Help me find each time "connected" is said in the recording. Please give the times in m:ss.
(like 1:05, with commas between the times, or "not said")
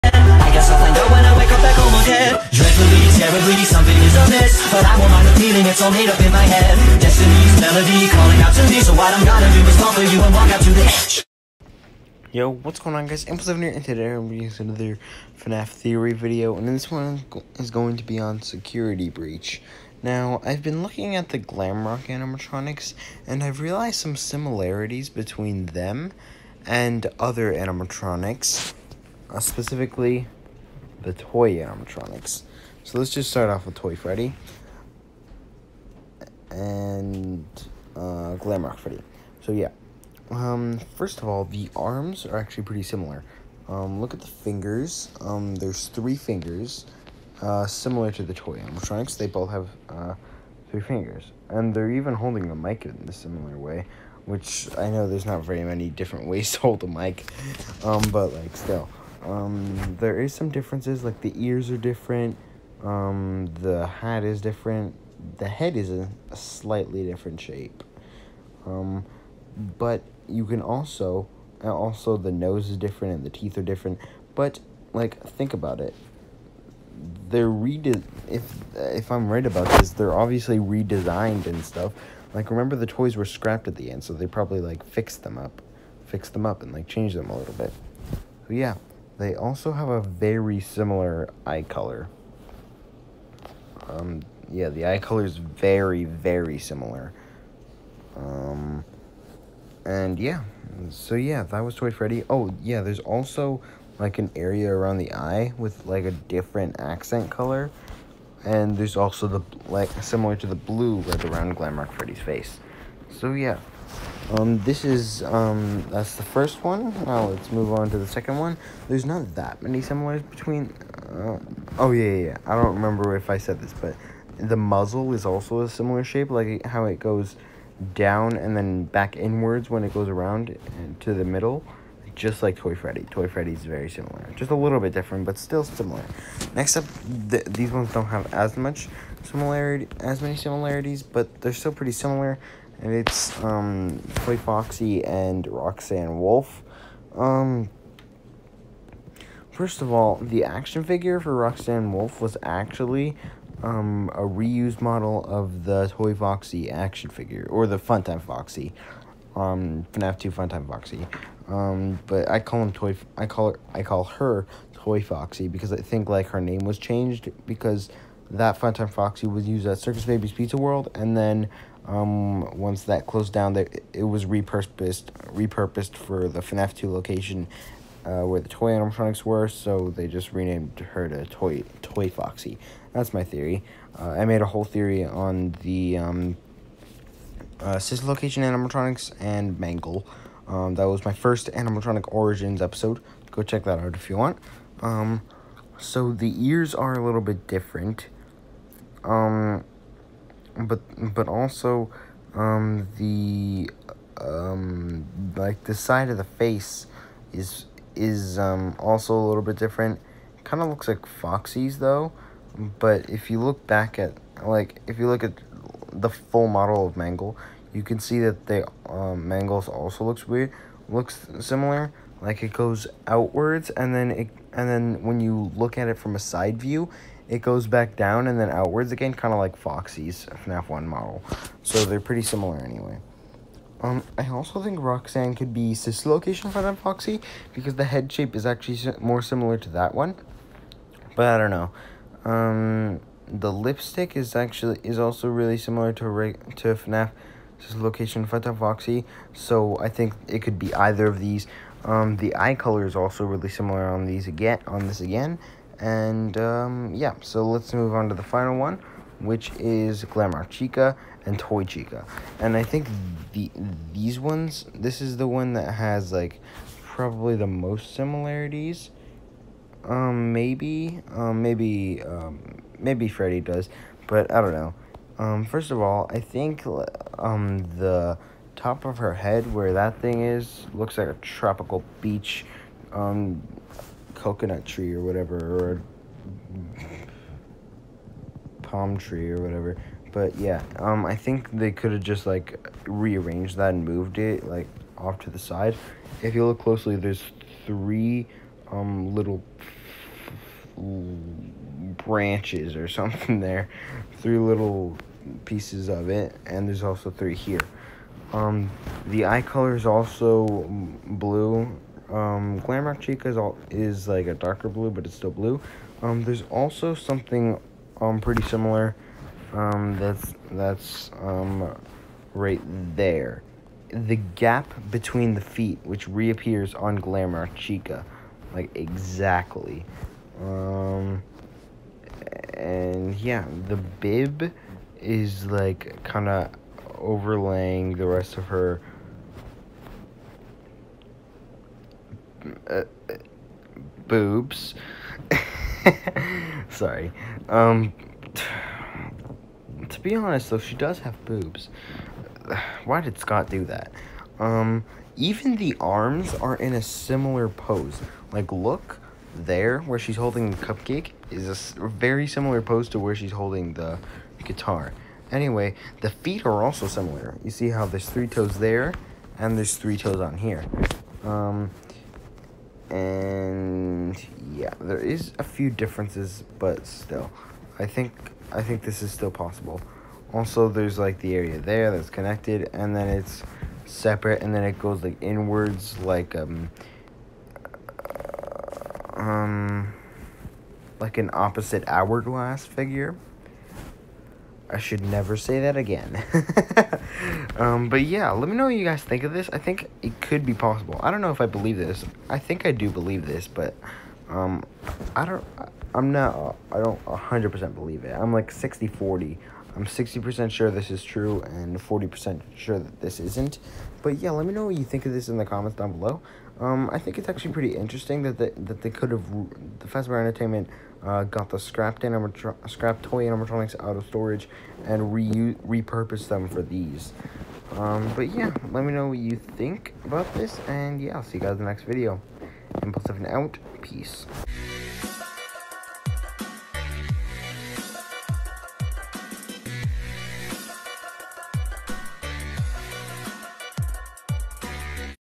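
6:22.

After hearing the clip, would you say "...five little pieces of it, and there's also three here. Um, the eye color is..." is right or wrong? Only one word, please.
wrong.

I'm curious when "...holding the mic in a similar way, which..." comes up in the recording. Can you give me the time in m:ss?
0:52.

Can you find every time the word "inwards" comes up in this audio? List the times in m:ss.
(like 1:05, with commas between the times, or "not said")
2:09, 6:25.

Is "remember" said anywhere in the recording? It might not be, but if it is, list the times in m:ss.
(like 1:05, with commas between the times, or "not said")
1:22, 2:02.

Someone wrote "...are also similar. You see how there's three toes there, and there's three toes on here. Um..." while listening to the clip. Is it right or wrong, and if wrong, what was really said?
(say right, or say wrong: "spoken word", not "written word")
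right.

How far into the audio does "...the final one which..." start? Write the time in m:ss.
4:18.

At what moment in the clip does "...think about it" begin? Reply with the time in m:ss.
1:15.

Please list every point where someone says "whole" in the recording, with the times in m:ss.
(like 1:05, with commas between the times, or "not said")
3:04.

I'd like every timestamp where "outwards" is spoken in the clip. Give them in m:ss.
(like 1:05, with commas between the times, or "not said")
3:43, 3:48.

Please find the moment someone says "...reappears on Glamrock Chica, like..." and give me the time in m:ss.
5:26.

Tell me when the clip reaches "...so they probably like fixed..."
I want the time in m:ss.
1:24.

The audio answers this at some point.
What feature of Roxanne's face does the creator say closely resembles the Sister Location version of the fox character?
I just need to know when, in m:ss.
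4:03.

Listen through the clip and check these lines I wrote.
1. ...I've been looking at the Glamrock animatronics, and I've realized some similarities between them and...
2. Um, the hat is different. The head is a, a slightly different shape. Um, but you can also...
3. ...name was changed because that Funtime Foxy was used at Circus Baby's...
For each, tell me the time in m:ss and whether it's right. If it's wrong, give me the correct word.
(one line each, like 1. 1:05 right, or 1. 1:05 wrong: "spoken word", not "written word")
1. 0:20 right
2. 1:02 right
3. 2:46 right.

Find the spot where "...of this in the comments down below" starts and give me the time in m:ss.
6:55.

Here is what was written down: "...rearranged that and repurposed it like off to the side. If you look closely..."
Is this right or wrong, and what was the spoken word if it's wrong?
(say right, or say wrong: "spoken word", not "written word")
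wrong: "moved", not "repurposed".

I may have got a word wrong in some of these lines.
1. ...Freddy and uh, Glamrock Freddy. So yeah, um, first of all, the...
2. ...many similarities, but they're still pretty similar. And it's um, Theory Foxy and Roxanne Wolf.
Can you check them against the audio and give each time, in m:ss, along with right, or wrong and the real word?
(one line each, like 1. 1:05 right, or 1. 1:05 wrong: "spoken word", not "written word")
1. 0:33 right
2. 2:20 wrong: "Toy", not "Theory".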